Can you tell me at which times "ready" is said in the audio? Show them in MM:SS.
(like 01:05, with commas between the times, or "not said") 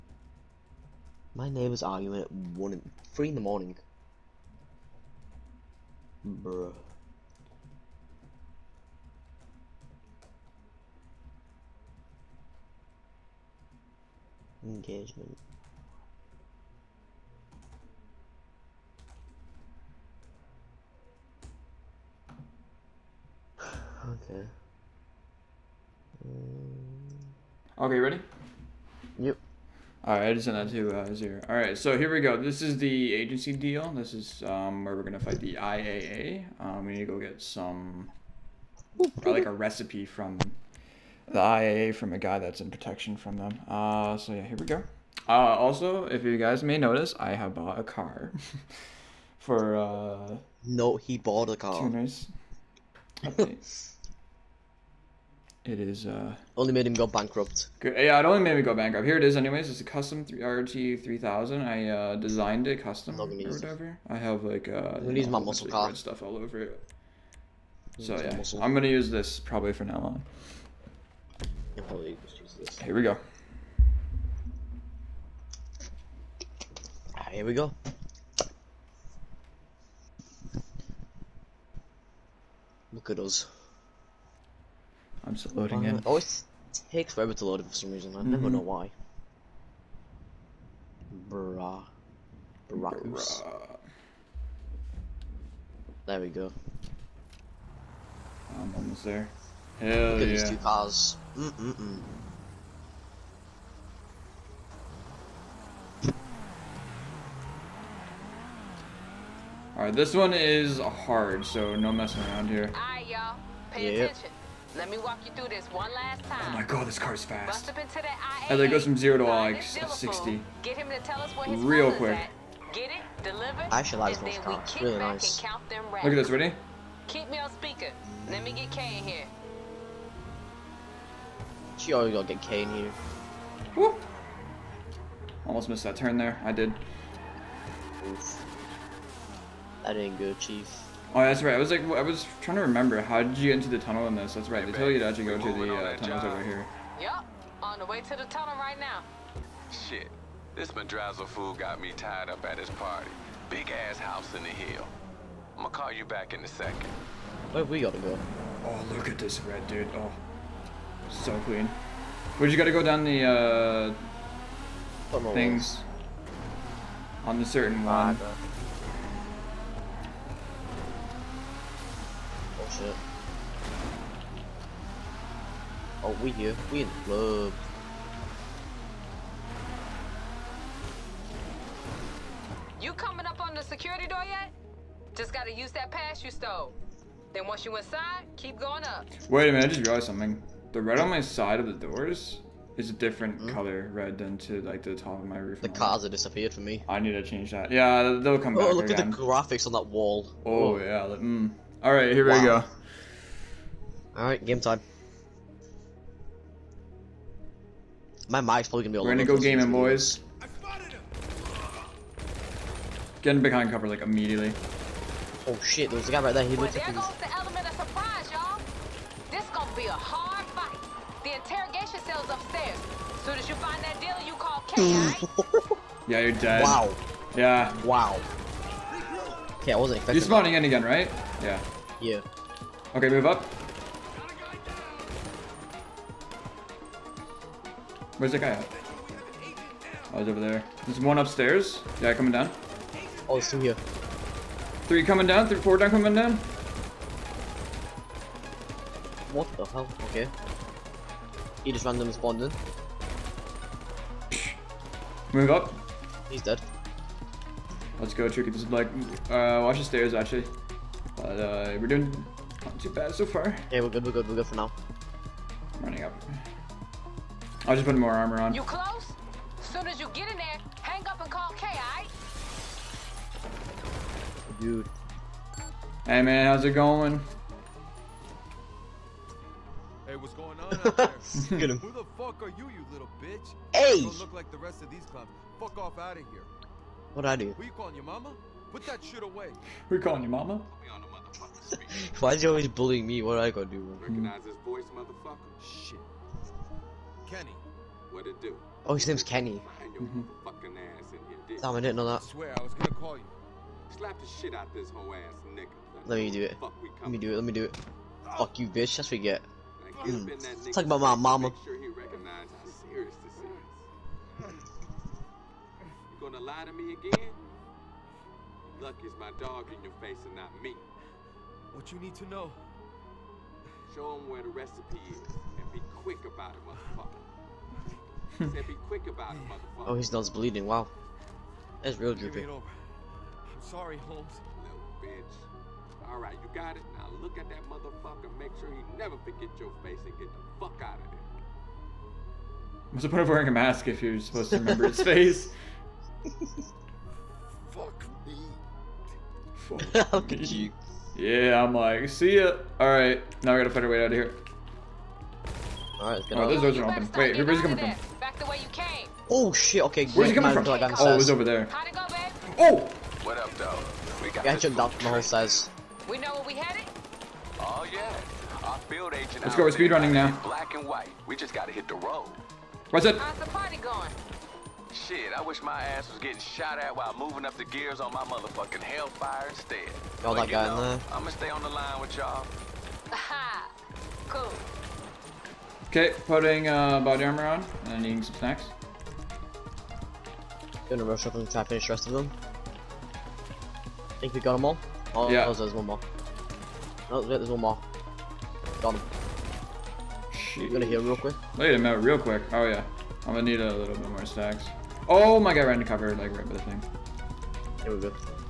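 00:27, 02:06.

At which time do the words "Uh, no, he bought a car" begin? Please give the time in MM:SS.
00:49.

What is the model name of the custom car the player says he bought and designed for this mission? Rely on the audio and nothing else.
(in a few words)
RT3000.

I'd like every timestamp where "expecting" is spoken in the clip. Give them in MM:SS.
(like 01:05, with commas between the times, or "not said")
03:49.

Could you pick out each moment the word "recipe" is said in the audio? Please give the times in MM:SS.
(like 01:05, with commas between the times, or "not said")
00:39, 05:24.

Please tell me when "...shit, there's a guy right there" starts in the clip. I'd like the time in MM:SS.
03:35.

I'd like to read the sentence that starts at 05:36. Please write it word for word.
Now look at that motherfucker, make sure he never forget your face and get the fuck out of there.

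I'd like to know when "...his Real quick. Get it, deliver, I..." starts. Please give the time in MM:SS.
02:01.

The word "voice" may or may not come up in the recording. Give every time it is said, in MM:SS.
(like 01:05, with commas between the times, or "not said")
04:54.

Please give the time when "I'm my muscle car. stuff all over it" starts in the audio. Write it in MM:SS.
01:04.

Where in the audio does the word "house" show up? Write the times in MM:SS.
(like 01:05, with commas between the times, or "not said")
02:33.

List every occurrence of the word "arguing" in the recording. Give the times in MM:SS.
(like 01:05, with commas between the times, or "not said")
00:01.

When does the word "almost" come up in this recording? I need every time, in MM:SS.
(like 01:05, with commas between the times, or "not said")
01:38, 02:15.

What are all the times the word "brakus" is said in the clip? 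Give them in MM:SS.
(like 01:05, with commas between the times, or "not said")
01:32.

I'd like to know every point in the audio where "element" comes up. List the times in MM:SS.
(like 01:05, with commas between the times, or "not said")
03:37.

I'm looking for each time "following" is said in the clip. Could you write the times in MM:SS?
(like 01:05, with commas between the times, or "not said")
not said.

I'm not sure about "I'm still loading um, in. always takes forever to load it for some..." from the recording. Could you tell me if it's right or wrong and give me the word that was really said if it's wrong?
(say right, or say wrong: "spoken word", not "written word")
right.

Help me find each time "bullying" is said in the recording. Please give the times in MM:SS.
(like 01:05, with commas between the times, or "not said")
04:52.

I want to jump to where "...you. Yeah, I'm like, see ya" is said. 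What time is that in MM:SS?
05:50.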